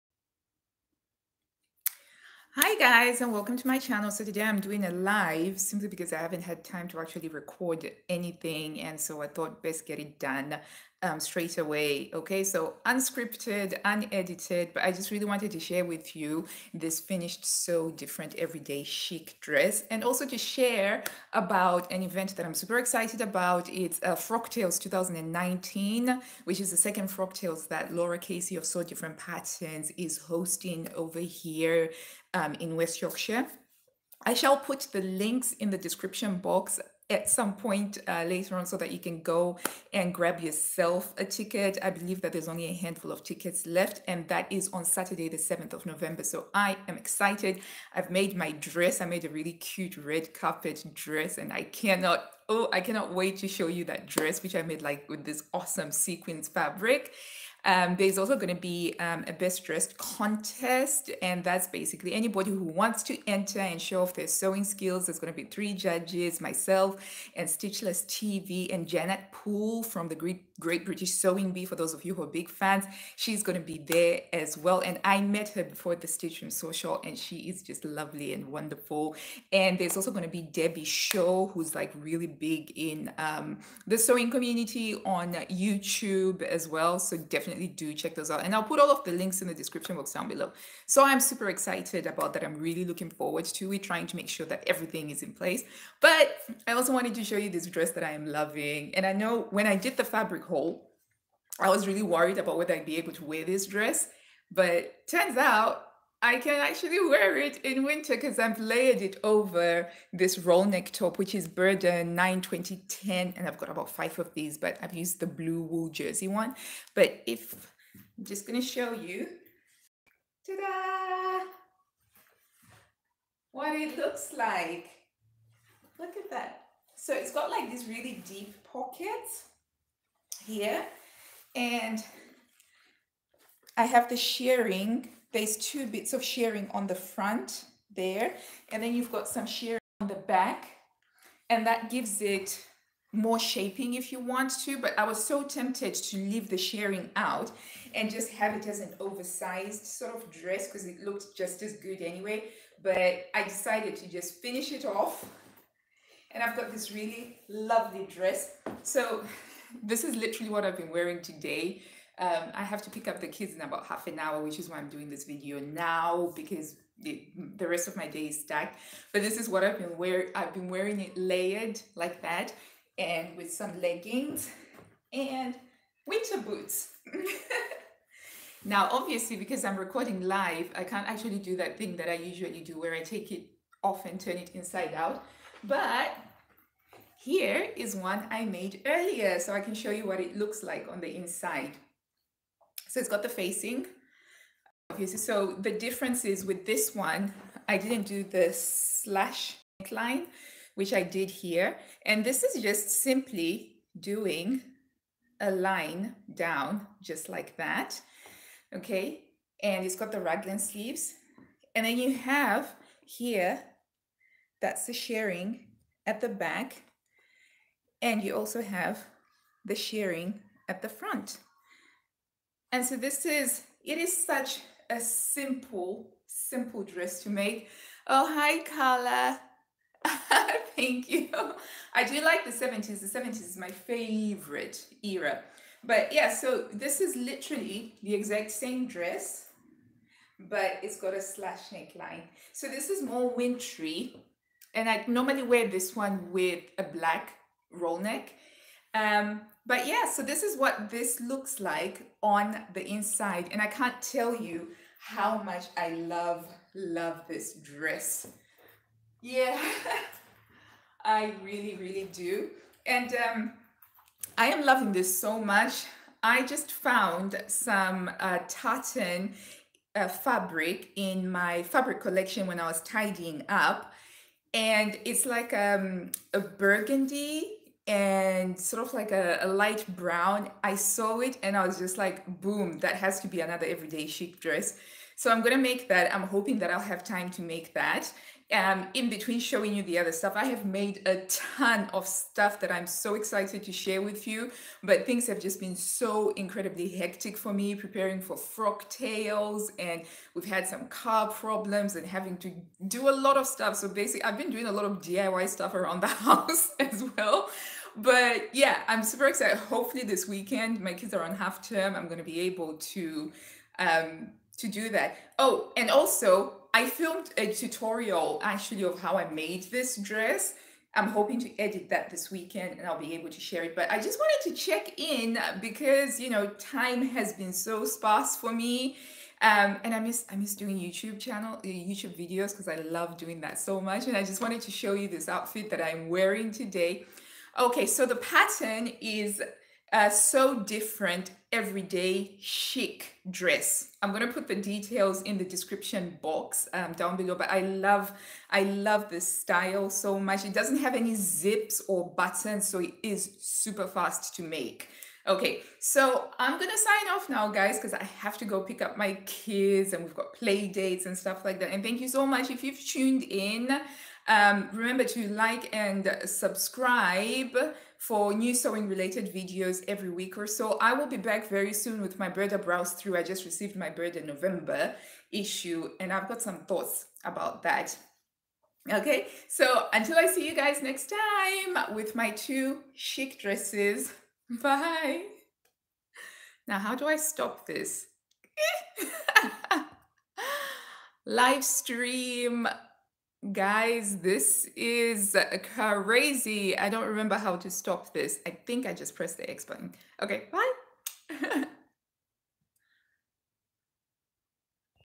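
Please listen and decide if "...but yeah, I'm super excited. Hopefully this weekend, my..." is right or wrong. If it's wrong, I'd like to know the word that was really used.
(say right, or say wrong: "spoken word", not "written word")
right.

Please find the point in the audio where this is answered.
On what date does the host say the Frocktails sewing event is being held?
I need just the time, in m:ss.
0:44.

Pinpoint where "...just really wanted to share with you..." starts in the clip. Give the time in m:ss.
0:14.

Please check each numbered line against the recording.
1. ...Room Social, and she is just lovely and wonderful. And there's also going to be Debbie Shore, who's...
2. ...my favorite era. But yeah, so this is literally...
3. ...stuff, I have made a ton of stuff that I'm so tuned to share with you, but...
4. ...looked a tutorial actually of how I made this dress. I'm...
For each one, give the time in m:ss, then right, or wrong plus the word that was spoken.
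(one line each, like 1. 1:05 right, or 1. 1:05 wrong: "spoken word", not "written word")
1. 1:16 right
2. 3:53 right
3. 4:50 wrong: "excited", not "tuned"
4. 5:16 wrong: "filmed", not "looked".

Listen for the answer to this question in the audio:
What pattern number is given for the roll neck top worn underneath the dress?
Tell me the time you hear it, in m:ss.
1:51.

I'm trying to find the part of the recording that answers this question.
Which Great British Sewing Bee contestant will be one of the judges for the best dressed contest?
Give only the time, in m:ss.
1:08.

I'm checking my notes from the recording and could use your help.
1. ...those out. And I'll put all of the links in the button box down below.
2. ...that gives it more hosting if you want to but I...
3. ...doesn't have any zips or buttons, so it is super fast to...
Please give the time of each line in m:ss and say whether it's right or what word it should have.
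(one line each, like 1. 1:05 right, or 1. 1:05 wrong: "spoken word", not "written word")
1. 1:28 wrong: "description", not "button"
2. 2:21 wrong: "shaping", not "hosting"
3. 5:50 right.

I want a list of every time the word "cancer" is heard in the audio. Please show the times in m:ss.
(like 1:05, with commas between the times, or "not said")
not said.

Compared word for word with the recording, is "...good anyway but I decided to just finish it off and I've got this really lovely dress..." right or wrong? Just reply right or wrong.
right.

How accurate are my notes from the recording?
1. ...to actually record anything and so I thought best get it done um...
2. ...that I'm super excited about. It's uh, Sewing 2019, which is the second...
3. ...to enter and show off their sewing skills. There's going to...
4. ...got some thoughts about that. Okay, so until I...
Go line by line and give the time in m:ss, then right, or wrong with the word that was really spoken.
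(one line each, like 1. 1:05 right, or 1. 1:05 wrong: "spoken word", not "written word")
1. 0:06 right
2. 0:22 wrong: "Frocktails", not "Sewing"
3. 1:03 right
4. 6:16 right.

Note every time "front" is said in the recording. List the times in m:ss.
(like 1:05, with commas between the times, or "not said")
2:16, 3:40.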